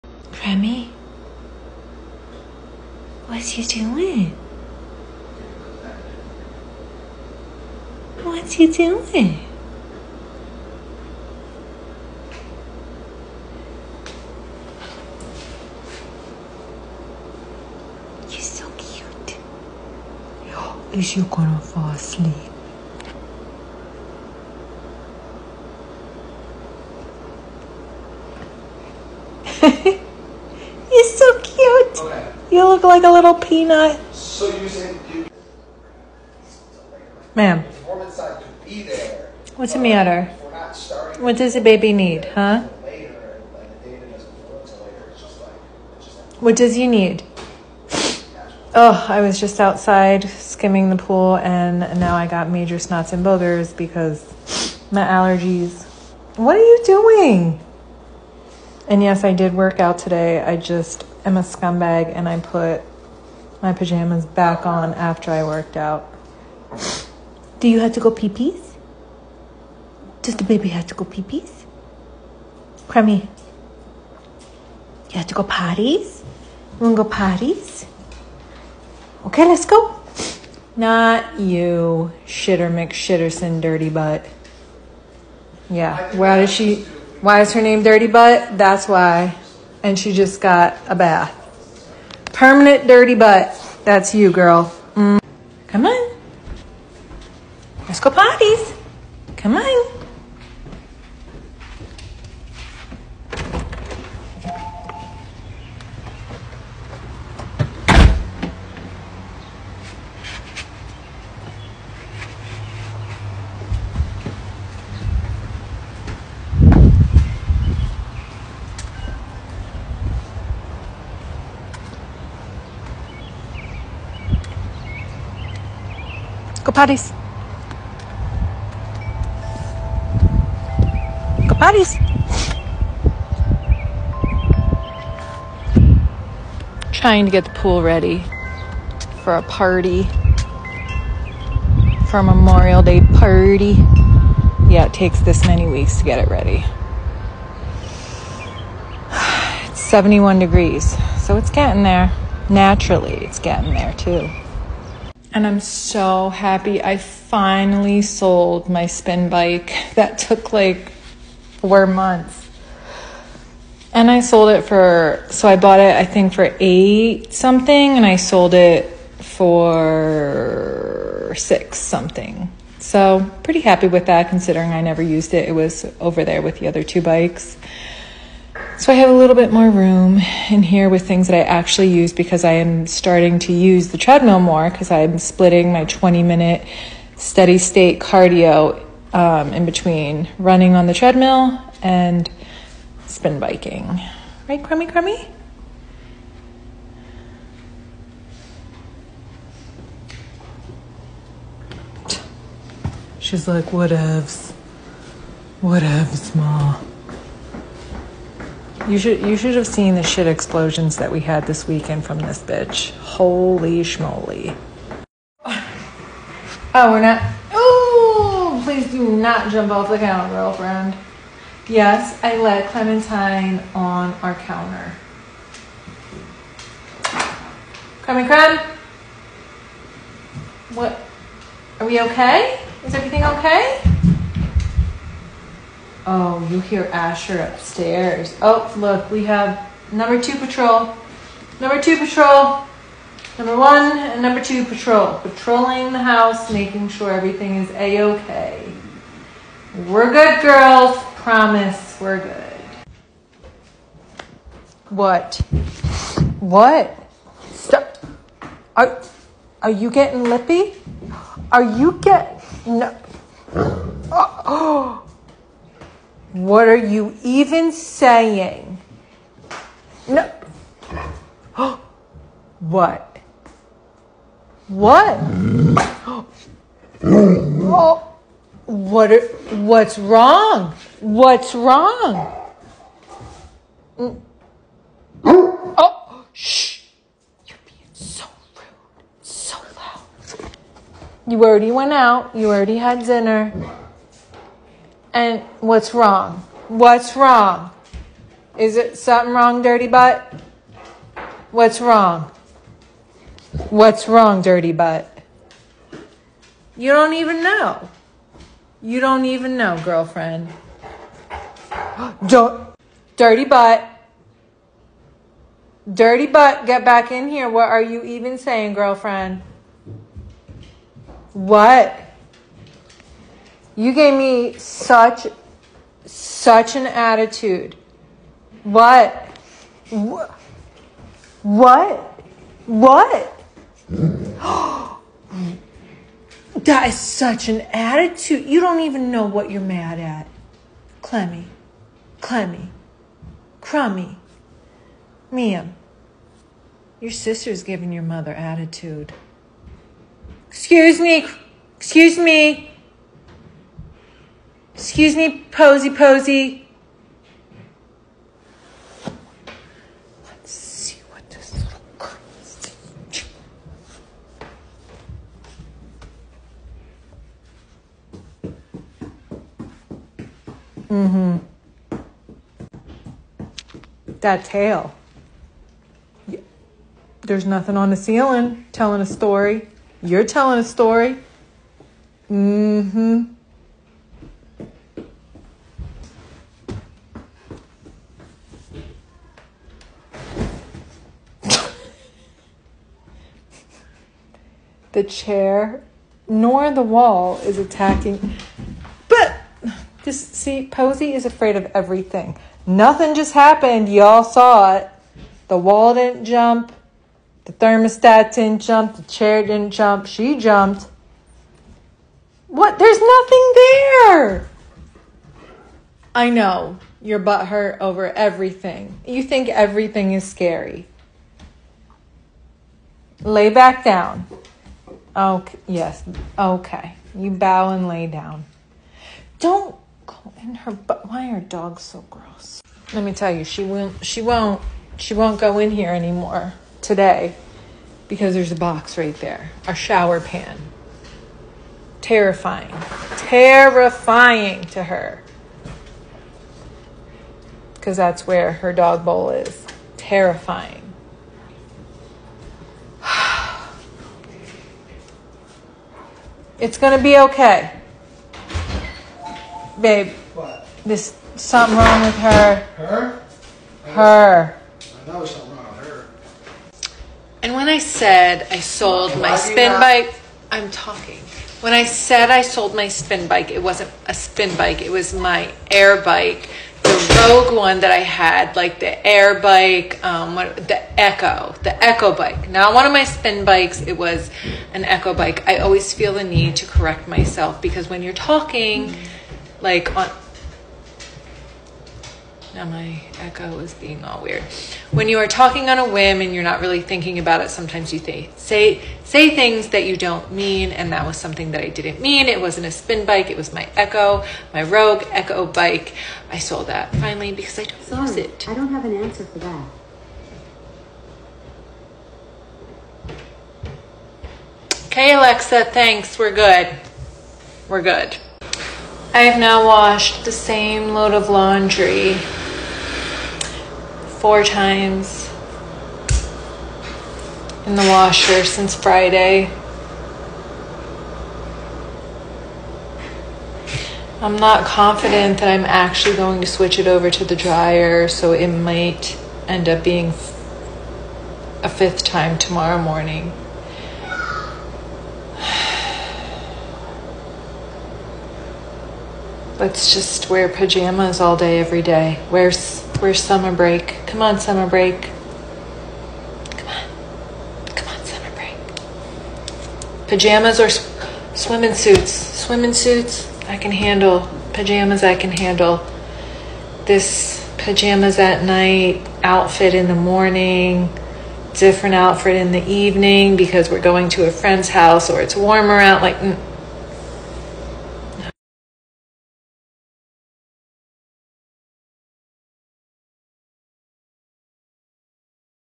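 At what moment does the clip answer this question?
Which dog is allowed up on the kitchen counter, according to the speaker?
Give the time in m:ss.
3:42.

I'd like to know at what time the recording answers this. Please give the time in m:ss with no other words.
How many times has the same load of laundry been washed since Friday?
8:44.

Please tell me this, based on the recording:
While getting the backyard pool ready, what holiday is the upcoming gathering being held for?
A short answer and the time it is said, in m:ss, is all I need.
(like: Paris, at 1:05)
Memorial Day, at 2:22.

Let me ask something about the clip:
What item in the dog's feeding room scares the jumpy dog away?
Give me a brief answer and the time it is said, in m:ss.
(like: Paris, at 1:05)
A shower pan, at 7:19.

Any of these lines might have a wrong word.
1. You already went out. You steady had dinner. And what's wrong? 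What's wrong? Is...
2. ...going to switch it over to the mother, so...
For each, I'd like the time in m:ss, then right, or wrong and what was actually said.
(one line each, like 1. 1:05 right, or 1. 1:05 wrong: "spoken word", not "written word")
1. 4:51 wrong: "already", not "steady"
2. 8:56 wrong: "dryer", not "mother".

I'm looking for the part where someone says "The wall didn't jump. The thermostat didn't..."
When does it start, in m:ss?
6:45.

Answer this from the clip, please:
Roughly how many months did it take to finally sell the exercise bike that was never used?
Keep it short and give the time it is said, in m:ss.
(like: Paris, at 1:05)
4, at 2:41.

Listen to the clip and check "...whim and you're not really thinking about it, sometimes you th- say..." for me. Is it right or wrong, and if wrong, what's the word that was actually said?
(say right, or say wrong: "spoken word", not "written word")
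right.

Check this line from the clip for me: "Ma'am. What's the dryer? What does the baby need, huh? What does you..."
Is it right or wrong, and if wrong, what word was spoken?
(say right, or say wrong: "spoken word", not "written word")
wrong: "matter", not "dryer".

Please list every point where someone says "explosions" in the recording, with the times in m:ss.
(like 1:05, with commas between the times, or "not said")
3:30.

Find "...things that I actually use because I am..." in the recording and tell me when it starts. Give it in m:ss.
3:01.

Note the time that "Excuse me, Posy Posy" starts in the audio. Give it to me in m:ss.
5:54.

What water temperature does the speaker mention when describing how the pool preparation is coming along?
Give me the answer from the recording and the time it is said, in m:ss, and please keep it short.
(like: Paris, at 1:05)
71 degrees, at 2:29.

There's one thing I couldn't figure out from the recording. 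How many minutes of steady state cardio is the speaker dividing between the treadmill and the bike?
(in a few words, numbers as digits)
20.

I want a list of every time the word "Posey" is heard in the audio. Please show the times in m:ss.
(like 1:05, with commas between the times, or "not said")
6:40.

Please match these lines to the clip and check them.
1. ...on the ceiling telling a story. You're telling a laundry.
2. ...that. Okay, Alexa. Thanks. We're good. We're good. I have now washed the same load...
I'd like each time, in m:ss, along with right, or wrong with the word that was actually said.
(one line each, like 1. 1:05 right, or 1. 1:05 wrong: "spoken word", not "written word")
1. 6:17 wrong: "story", not "laundry"
2. 8:29 right.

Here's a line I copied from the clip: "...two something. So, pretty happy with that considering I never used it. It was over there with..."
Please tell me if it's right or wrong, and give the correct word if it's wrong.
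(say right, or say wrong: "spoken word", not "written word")
wrong: "six", not "two".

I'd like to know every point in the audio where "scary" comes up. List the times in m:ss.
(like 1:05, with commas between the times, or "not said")
7:00.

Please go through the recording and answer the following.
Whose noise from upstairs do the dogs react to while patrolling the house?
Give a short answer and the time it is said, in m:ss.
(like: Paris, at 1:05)
Asher, at 3:56.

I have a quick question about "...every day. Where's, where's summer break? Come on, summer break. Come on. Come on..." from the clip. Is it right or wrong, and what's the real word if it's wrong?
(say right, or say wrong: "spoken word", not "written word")
right.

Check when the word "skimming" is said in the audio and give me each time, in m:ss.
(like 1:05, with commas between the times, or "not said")
0:50.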